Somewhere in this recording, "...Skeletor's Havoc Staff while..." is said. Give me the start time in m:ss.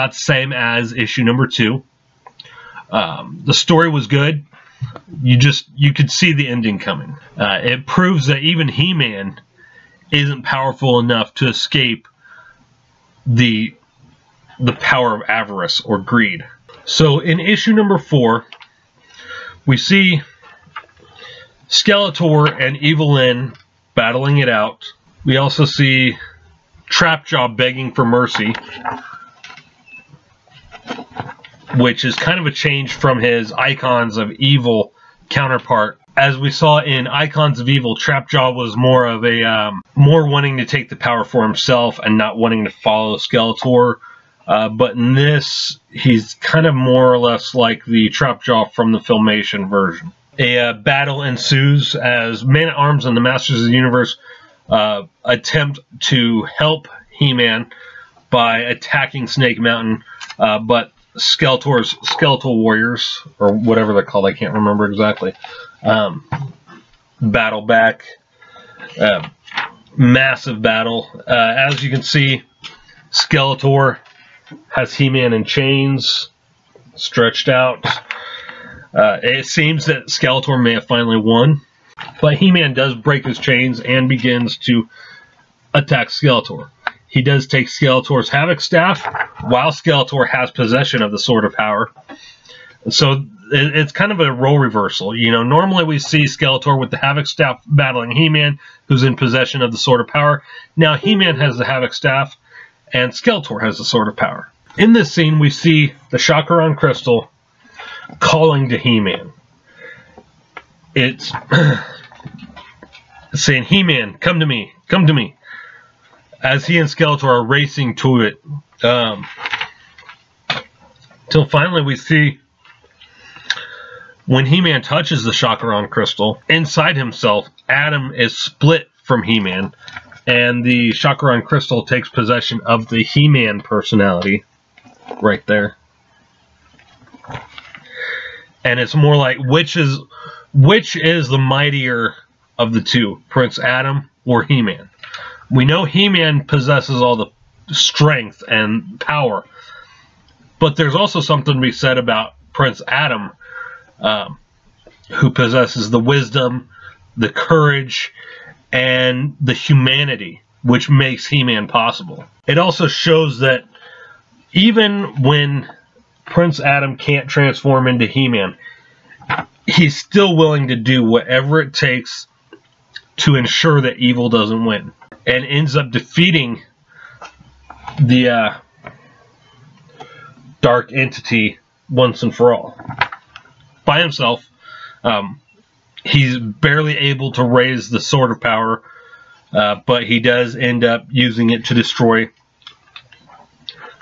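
1:27.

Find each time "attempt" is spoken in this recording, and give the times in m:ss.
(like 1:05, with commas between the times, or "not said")
0:55.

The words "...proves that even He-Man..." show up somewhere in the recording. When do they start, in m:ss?
0:07.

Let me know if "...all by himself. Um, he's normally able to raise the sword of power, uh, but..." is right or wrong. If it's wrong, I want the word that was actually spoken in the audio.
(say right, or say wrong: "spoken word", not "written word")
wrong: "barely", not "normally".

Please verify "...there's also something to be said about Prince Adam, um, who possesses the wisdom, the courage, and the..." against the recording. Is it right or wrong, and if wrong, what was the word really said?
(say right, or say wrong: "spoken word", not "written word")
right.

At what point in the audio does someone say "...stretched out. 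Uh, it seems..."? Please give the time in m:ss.
1:16.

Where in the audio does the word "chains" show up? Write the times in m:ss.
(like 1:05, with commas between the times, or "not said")
1:15, 1:23.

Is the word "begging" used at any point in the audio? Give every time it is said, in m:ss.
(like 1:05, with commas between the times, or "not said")
0:27.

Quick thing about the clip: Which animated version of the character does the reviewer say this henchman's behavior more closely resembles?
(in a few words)
Filmation.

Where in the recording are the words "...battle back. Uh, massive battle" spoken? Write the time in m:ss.
1:07.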